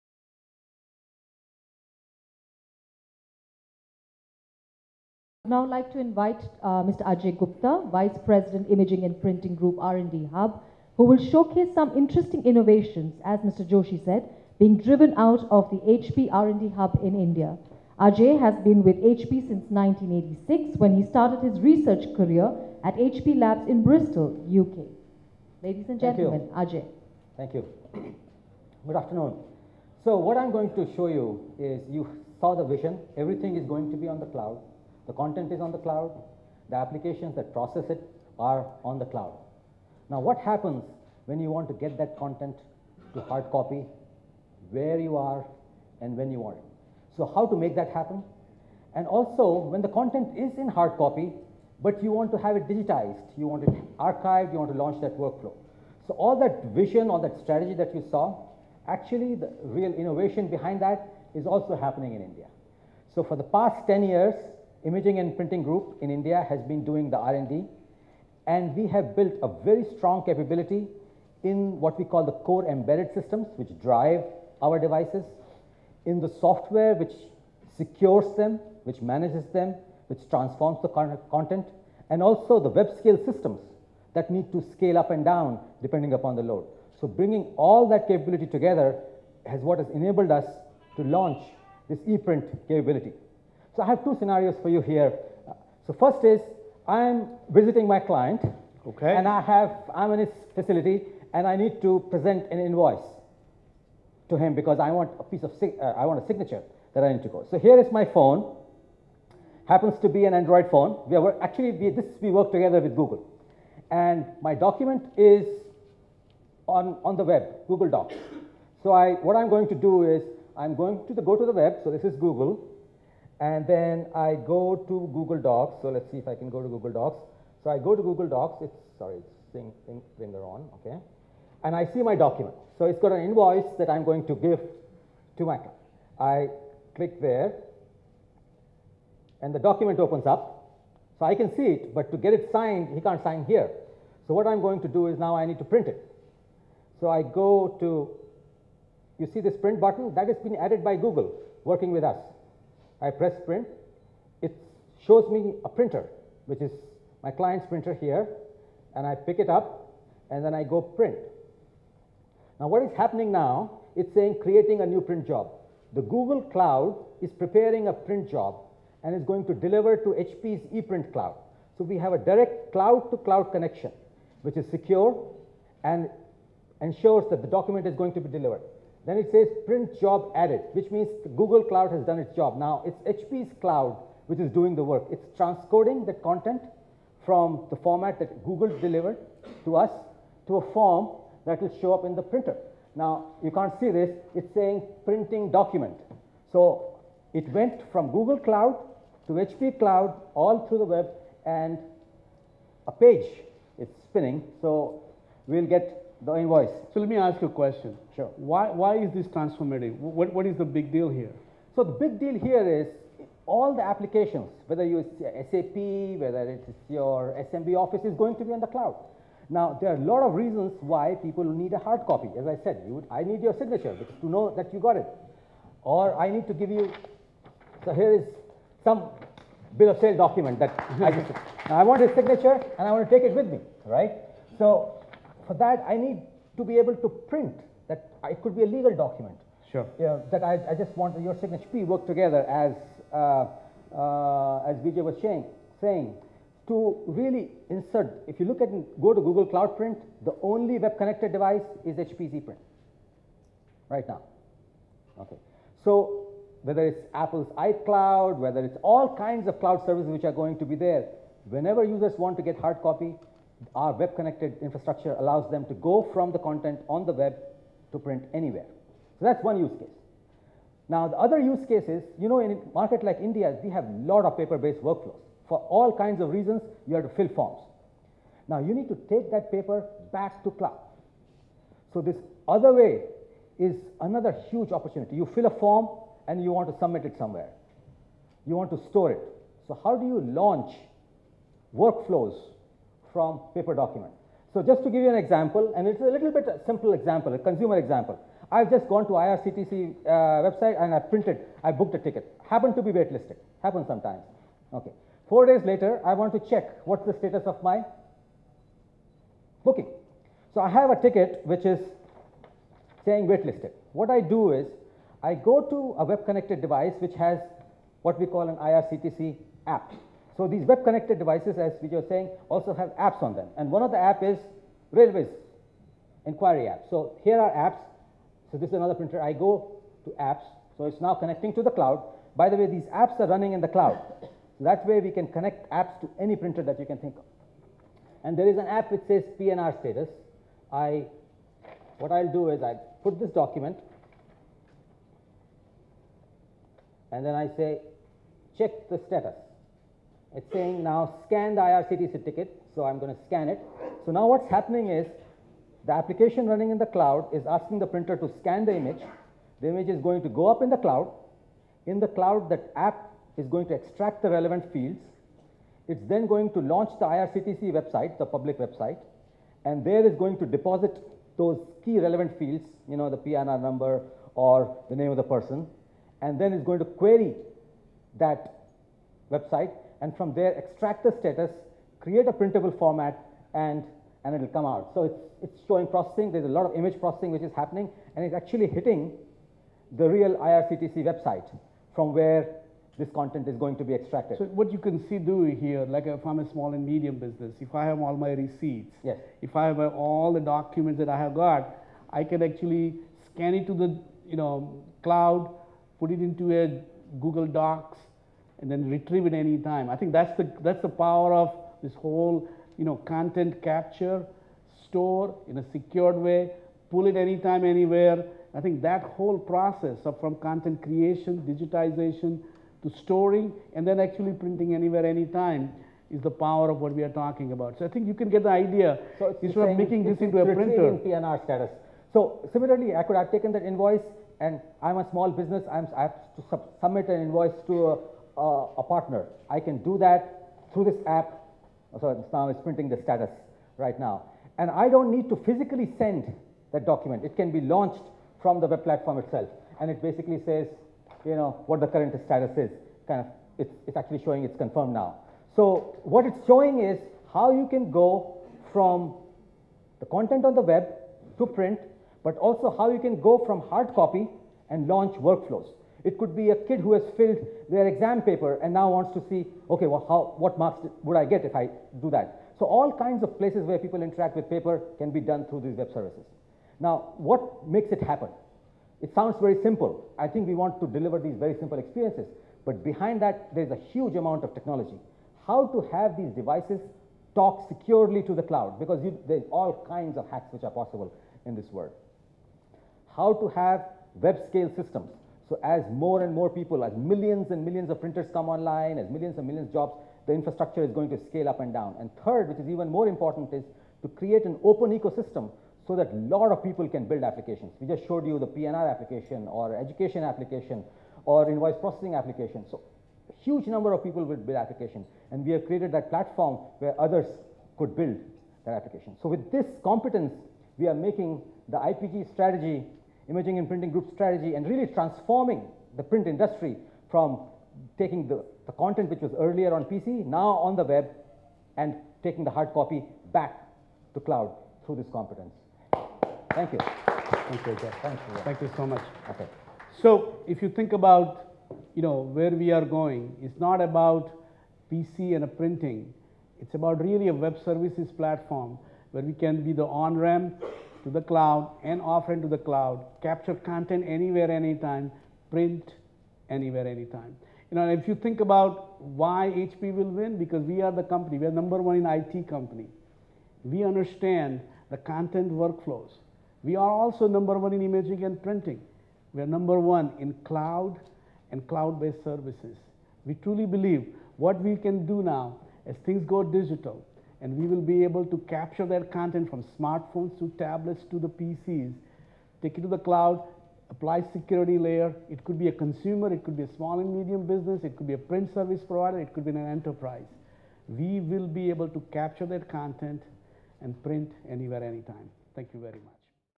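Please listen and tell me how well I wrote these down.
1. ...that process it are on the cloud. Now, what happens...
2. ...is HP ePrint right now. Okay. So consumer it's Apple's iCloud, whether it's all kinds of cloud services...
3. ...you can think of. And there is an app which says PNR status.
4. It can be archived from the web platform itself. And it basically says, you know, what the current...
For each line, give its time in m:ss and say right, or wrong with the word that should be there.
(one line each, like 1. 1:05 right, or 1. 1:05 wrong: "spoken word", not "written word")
1. 0:37 right
2. 4:11 wrong: "whether", not "consumer"
3. 5:36 right
4. 7:27 wrong: "launched", not "archived".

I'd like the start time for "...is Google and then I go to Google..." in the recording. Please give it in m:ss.
2:02.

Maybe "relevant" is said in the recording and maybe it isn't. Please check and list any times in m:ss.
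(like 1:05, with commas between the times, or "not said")
6:04, 6:11.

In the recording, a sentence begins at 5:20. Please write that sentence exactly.
So these web connected devices, as we were saying, also have apps on them.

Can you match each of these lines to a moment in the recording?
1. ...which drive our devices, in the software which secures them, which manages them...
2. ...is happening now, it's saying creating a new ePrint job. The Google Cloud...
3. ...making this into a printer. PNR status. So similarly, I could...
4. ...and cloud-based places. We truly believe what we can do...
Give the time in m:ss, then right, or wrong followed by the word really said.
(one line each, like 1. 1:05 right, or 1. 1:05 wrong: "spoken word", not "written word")
1. 1:13 right
2. 2:42 wrong: "print", not "ePrint"
3. 7:09 right
4. 9:31 wrong: "services", not "places".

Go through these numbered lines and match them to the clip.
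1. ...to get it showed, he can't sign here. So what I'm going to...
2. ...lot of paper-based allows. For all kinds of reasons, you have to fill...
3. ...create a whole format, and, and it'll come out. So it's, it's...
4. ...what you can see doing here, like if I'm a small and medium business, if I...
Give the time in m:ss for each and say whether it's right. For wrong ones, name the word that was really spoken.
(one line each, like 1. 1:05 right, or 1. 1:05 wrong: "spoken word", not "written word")
1. 2:22 wrong: "signed", not "showed"
2. 4:33 wrong: "workflows", not "allows"
3. 6:21 wrong: "printable", not "whole"
4. 6:34 right.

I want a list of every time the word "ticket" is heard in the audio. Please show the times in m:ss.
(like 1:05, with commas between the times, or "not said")
5:01, 5:11, 5:52.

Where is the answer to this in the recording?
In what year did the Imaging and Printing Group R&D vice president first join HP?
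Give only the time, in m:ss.
0:19.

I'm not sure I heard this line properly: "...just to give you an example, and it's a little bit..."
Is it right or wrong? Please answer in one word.
right.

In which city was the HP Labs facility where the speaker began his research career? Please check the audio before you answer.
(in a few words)
Bristol.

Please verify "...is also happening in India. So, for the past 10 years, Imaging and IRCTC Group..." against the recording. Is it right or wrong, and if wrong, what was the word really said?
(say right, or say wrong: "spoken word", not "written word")
wrong: "Printing", not "IRCTC".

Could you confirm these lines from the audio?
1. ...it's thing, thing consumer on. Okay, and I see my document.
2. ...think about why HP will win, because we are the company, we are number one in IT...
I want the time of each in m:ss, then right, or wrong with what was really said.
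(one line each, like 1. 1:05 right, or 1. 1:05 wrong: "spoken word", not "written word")
1. 2:09 wrong: "finger", not "consumer"
2. 9:18 right.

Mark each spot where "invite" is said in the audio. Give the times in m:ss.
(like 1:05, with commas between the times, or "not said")
0:05.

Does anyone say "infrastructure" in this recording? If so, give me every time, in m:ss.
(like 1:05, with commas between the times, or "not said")
4:24, 8:20.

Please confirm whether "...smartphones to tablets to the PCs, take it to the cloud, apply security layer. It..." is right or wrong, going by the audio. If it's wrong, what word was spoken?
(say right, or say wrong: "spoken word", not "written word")
right.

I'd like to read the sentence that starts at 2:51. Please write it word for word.
So we have a direct cloud-to-cloud -cloud connection, which is secure and ensures that the document is going to be delivered.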